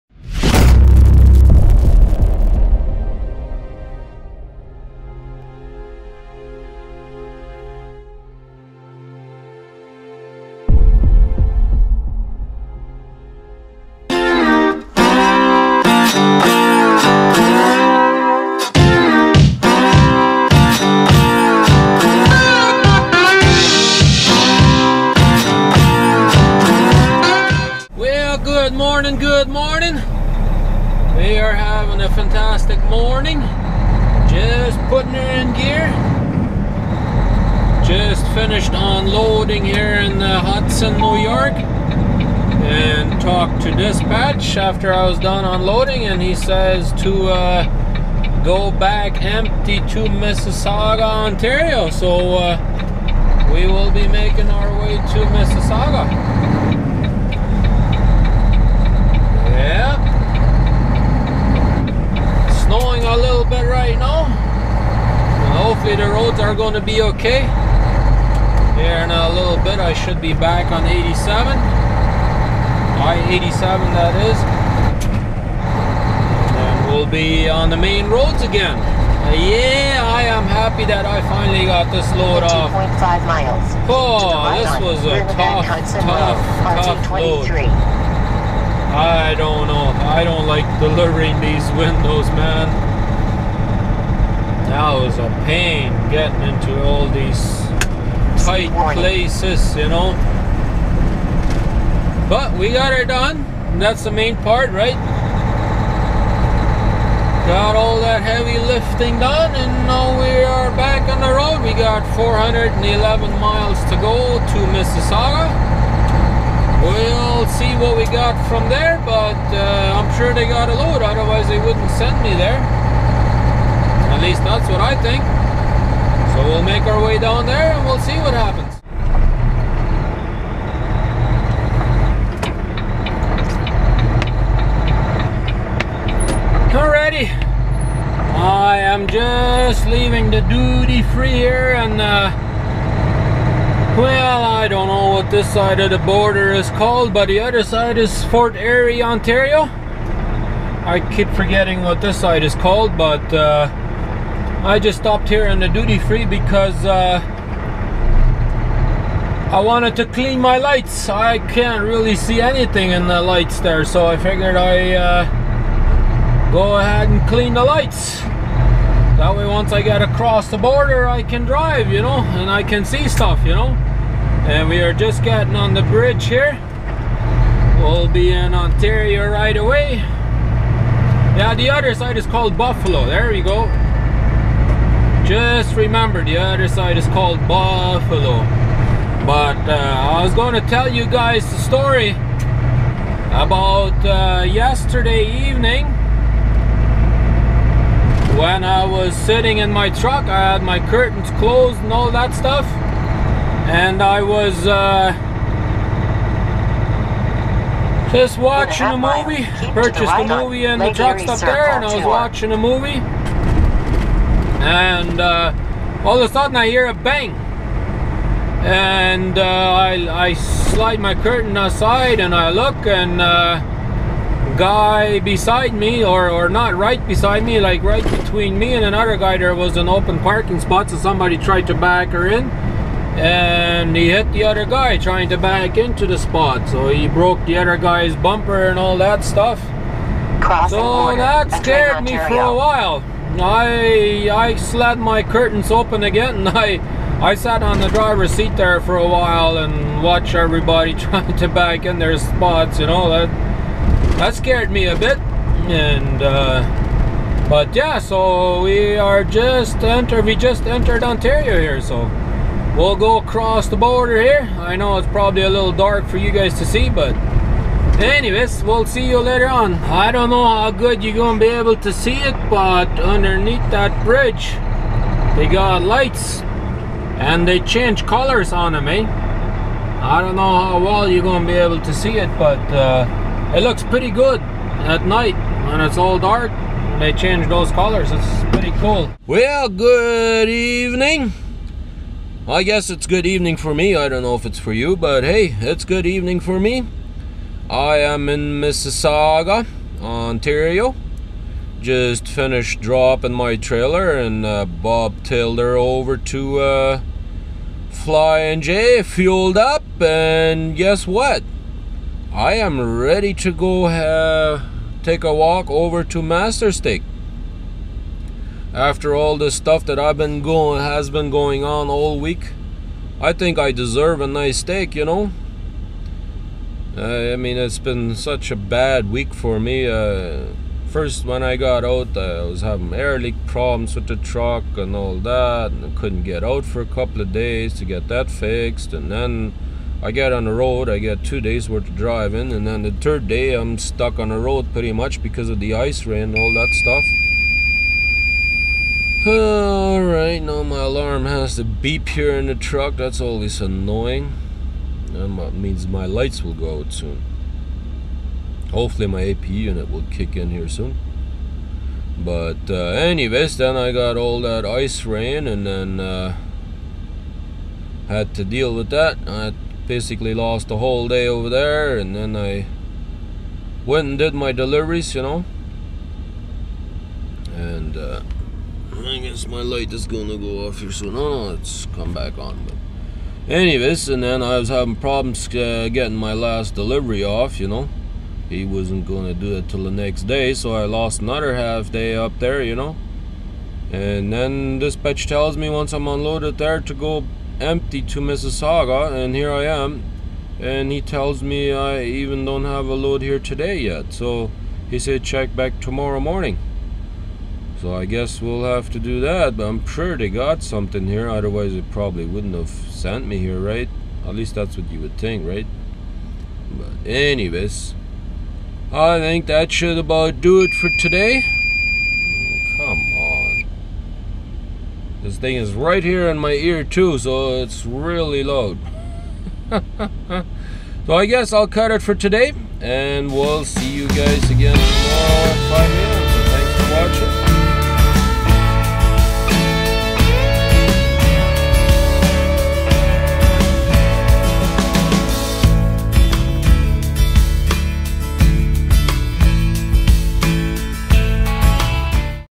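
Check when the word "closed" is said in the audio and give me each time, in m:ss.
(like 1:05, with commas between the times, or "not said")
3:21.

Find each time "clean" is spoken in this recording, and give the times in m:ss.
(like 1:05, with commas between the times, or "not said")
2:40, 2:47.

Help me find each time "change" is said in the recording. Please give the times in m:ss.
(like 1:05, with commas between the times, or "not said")
4:37, 4:47.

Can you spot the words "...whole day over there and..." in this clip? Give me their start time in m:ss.
6:10.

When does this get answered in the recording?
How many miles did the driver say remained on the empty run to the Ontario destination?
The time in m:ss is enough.
1:52.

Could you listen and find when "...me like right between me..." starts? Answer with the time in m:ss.
3:47.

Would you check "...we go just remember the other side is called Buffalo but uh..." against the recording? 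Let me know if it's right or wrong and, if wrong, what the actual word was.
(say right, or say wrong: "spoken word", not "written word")
right.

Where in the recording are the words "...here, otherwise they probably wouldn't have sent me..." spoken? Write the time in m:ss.
6:51.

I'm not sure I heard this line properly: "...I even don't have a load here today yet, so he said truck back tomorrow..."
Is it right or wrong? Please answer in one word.
wrong.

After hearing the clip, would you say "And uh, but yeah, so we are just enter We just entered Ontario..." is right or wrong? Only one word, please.
right.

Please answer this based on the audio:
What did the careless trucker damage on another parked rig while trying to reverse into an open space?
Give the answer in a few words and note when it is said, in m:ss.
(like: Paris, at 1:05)
bumper, at 3:58.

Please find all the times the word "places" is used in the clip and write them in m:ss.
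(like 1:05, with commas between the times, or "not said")
1:38.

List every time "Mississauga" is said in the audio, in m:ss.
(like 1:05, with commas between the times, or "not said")
0:50, 0:55, 1:54, 4:58, 6:38.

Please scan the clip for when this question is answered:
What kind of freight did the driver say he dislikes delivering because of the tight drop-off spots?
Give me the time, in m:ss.
1:31.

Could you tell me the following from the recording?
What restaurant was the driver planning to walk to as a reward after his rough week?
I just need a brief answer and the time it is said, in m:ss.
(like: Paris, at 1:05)
Master Steak, at 5:16.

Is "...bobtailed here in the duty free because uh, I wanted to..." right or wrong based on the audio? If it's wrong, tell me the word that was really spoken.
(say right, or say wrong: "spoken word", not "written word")
wrong: "stopped", not "bobtailed".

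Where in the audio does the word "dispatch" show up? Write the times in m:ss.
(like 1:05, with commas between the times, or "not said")
0:43.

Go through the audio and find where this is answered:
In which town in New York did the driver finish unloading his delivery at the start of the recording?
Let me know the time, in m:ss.
0:40.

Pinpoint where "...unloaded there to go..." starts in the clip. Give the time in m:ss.
6:36.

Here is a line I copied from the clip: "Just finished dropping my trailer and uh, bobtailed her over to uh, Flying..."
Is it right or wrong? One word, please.
right.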